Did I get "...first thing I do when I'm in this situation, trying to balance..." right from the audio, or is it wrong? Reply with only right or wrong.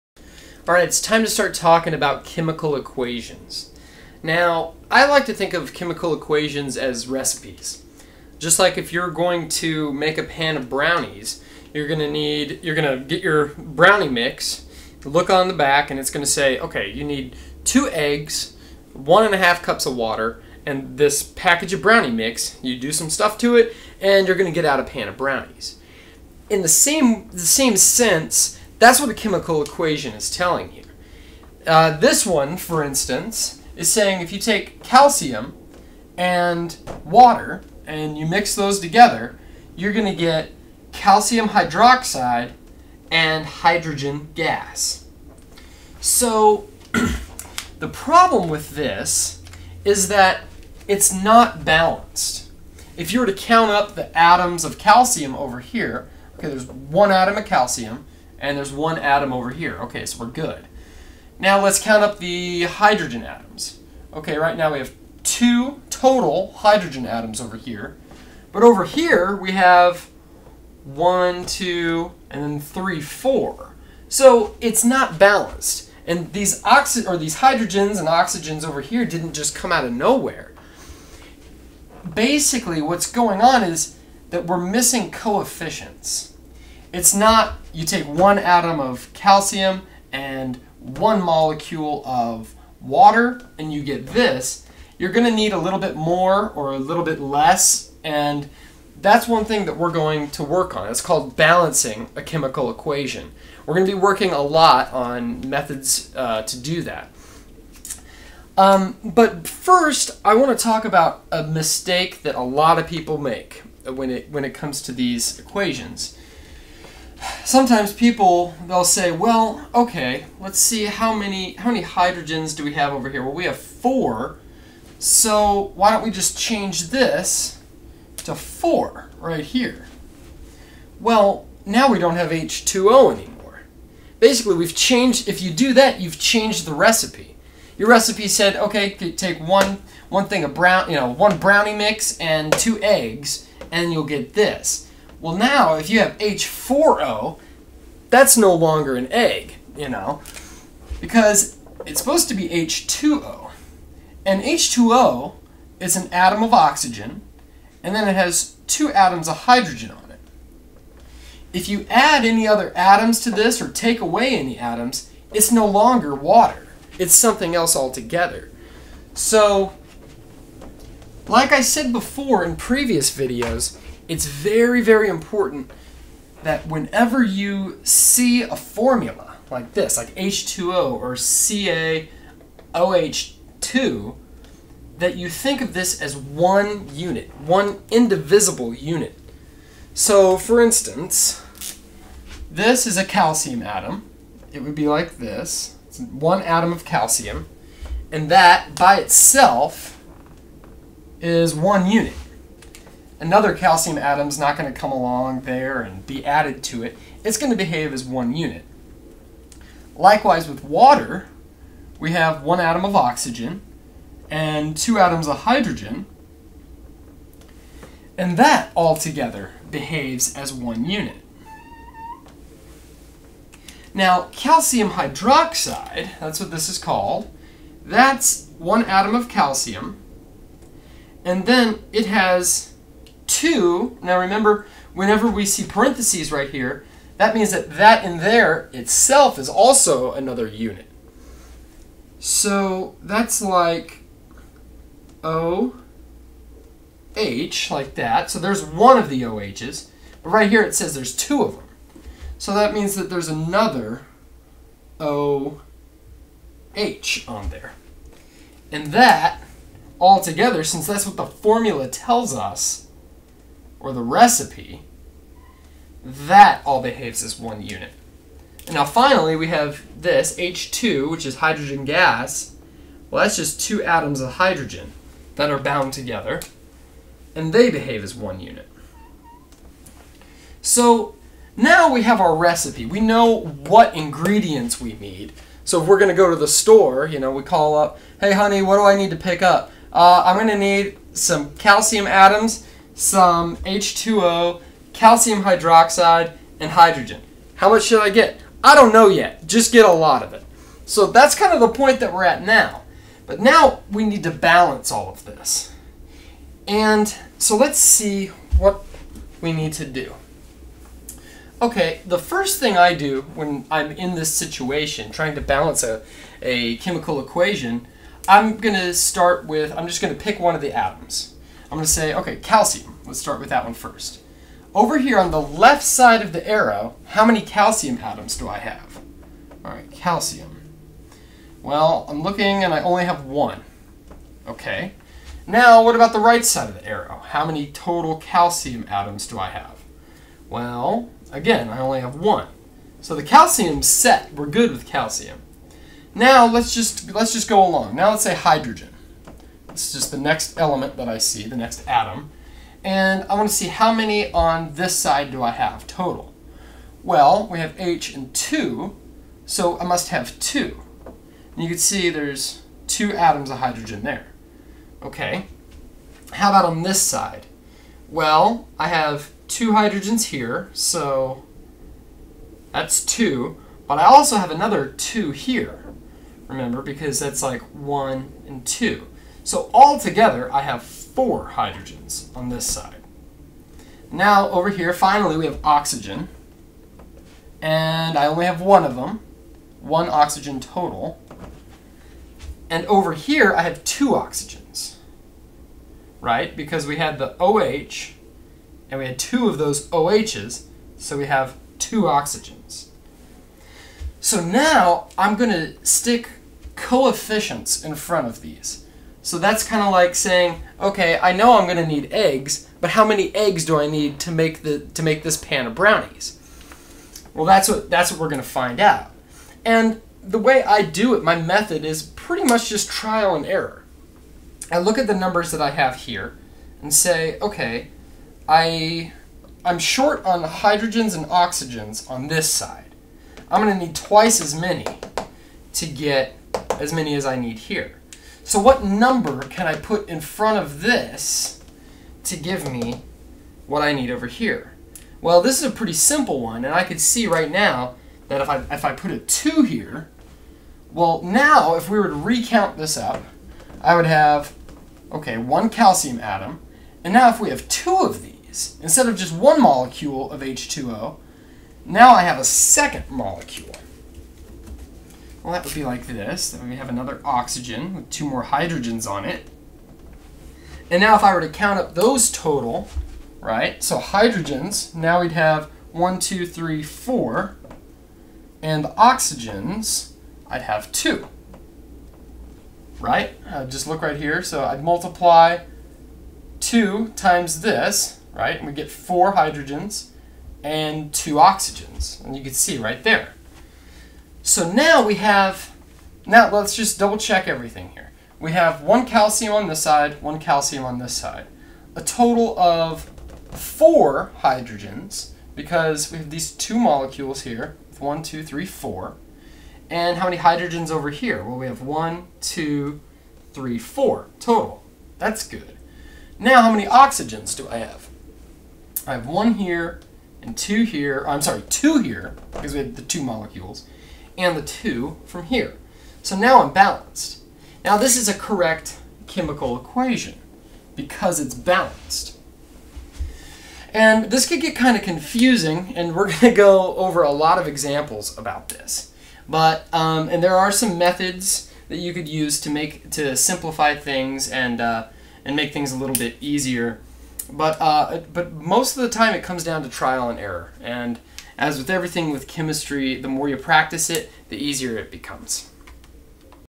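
right.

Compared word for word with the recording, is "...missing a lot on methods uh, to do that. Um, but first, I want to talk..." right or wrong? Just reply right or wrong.
wrong.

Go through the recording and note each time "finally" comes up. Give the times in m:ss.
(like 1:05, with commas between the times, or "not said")
4:28, 6:24.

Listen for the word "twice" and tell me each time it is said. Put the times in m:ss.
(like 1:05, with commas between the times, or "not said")
7:13.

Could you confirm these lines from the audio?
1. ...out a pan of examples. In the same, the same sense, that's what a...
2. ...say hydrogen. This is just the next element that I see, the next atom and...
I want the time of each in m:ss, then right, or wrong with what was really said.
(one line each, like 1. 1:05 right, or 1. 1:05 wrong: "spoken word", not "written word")
1. 0:24 wrong: "brownies", not "examples"
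2. 5:48 right.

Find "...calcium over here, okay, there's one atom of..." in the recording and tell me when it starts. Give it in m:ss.
0:54.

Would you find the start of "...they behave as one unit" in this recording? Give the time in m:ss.
4:37.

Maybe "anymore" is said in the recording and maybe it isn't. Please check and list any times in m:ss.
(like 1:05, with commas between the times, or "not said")
2:13.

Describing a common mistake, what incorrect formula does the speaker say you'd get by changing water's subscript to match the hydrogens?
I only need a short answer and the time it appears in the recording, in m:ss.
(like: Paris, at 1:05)
H4O, at 2:26.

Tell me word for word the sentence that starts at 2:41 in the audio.
If you add any other atoms to this or take away any atoms, it's no longer water.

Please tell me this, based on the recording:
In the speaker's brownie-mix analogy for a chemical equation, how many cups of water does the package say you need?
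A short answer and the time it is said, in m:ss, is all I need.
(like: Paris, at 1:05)
1.5 cups, at 0:18.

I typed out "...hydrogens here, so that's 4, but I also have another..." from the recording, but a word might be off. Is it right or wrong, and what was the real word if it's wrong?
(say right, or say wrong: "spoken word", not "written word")
wrong: "2", not "4".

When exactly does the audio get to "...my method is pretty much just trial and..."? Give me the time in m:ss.
7:01.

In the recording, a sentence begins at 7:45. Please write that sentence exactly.
Well, that would be like this.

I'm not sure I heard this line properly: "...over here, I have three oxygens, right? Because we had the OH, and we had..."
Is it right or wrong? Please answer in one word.
wrong.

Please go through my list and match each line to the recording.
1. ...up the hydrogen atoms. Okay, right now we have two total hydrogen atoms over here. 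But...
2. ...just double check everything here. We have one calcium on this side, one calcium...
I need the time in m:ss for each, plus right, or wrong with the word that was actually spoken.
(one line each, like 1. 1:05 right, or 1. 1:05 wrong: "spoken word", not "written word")
1. 1:02 right
2. 8:16 right.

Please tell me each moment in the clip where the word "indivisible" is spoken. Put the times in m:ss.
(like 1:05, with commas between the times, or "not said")
3:07.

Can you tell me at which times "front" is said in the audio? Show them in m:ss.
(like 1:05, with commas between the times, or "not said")
6:47, 7:20.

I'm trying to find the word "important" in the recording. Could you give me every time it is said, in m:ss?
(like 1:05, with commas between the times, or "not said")
2:55.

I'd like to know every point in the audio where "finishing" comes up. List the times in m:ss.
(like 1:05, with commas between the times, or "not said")
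not said.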